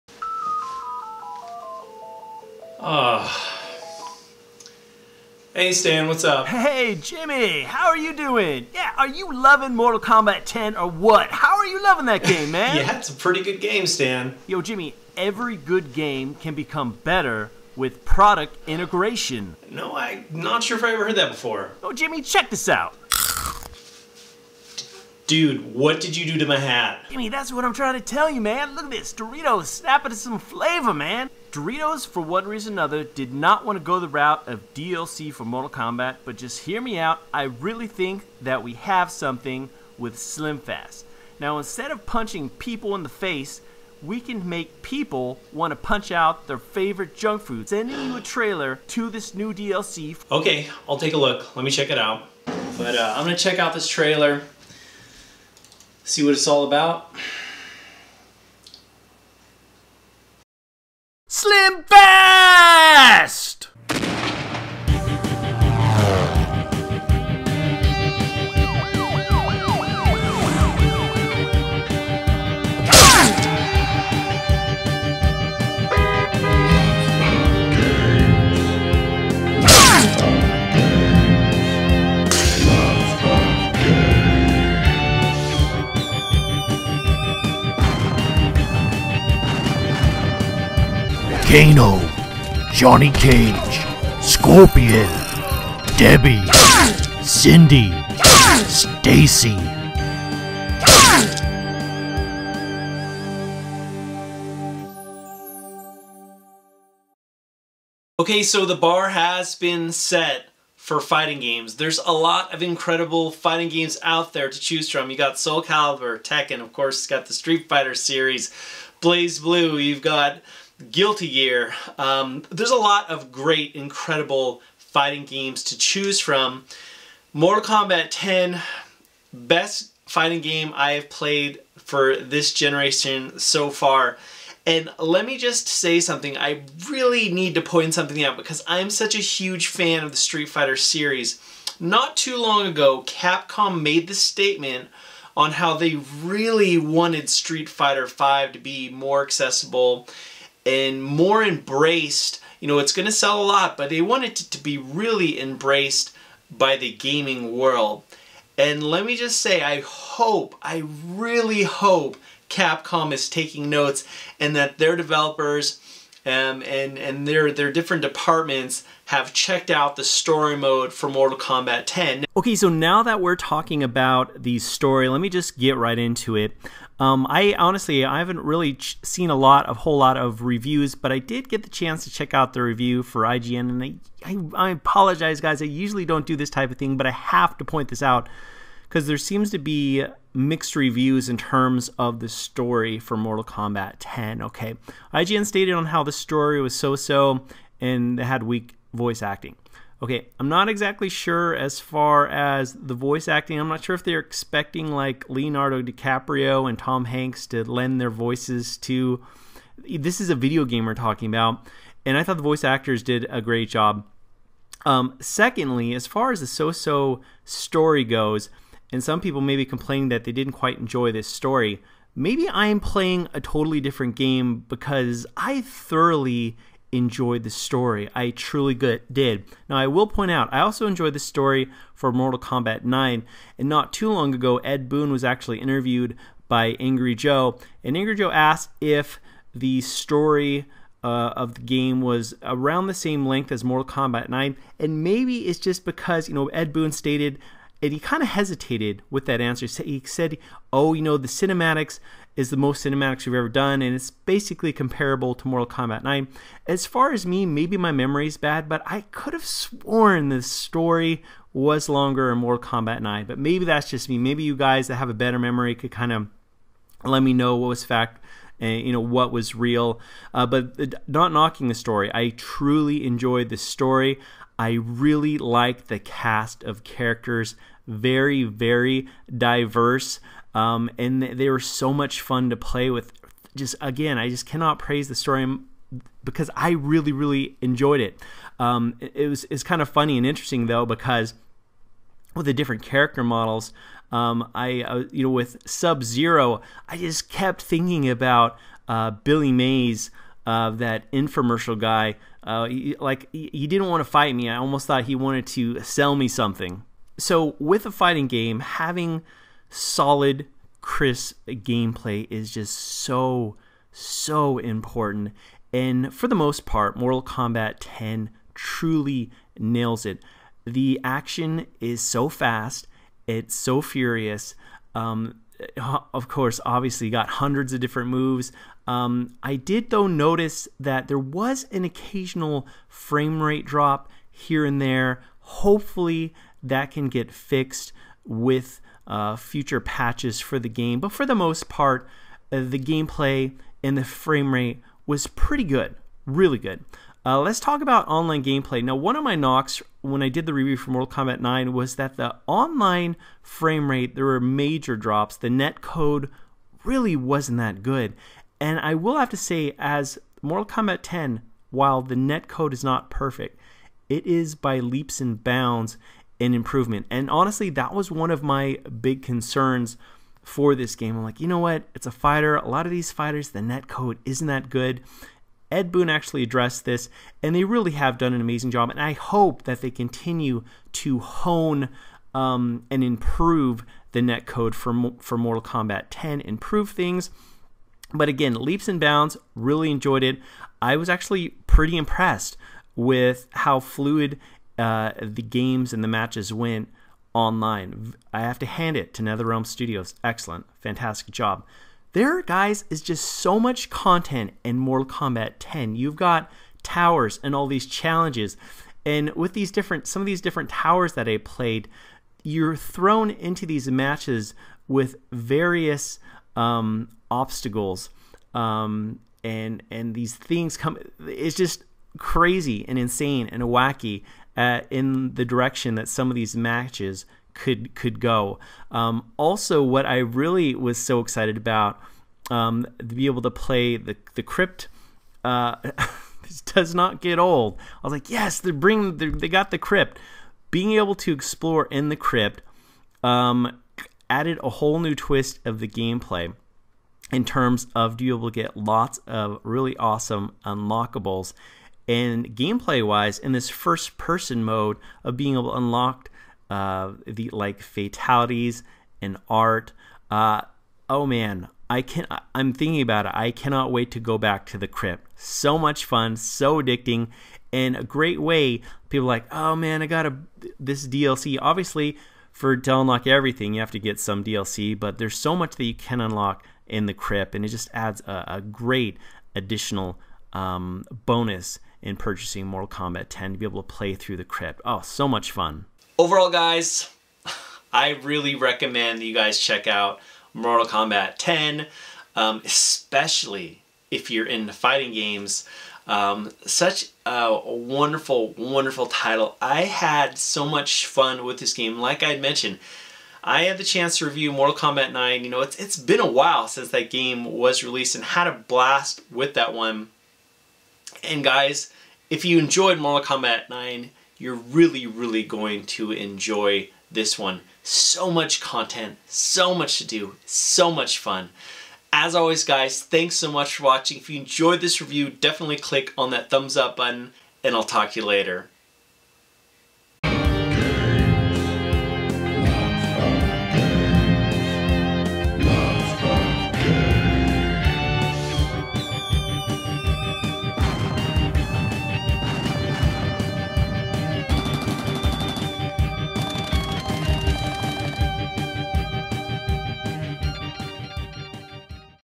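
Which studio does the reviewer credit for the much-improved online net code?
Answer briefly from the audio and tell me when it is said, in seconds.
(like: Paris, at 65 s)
NetherRealm Studios, at 399 s.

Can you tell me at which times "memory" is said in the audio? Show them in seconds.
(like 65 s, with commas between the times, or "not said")
257 s, 265 s.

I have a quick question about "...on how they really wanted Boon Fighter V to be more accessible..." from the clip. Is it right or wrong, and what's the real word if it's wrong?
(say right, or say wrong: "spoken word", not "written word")
wrong: "Street", not "Boon".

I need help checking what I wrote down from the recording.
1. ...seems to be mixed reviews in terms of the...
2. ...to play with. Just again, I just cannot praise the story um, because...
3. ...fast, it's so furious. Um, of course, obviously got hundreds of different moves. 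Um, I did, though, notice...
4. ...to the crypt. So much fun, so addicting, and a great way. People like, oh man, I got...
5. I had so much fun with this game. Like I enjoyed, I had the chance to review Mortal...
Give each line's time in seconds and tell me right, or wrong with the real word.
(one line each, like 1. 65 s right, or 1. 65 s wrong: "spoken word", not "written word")
1. 189 s right
2. 282 s right
3. 322 s right
4. 464 s right
5. 499 s wrong: "mentioned", not "enjoyed".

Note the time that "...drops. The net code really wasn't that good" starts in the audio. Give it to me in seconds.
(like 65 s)
354 s.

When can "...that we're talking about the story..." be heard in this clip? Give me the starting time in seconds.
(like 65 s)
173 s.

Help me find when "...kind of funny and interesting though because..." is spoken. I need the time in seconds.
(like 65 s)
289 s.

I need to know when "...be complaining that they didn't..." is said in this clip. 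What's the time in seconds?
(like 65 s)
219 s.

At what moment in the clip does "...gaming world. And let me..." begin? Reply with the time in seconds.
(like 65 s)
156 s.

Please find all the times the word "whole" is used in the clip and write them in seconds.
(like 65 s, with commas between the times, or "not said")
179 s, 444 s.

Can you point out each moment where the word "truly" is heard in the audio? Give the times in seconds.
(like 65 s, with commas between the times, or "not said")
228 s, 272 s, 318 s.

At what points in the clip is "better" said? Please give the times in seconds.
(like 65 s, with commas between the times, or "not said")
17 s, 265 s.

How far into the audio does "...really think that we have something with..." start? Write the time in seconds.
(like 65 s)
37 s.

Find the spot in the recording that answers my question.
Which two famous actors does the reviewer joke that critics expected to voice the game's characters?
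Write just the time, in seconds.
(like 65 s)
205 s.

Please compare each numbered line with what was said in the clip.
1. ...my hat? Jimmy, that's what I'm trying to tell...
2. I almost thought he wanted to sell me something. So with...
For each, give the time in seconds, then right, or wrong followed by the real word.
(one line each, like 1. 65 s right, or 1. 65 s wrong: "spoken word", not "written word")
1. 26 s right
2. 304 s right.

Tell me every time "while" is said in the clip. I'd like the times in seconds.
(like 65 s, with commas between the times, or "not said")
361 s, 506 s.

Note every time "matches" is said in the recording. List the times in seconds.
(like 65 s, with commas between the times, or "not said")
396 s, 413 s, 426 s.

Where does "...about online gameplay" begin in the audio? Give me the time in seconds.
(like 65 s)
347 s.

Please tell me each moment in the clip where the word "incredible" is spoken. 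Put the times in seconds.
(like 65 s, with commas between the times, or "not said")
112 s, 123 s.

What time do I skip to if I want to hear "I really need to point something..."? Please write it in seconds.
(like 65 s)
136 s.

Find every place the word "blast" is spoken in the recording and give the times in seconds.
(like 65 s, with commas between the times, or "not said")
508 s.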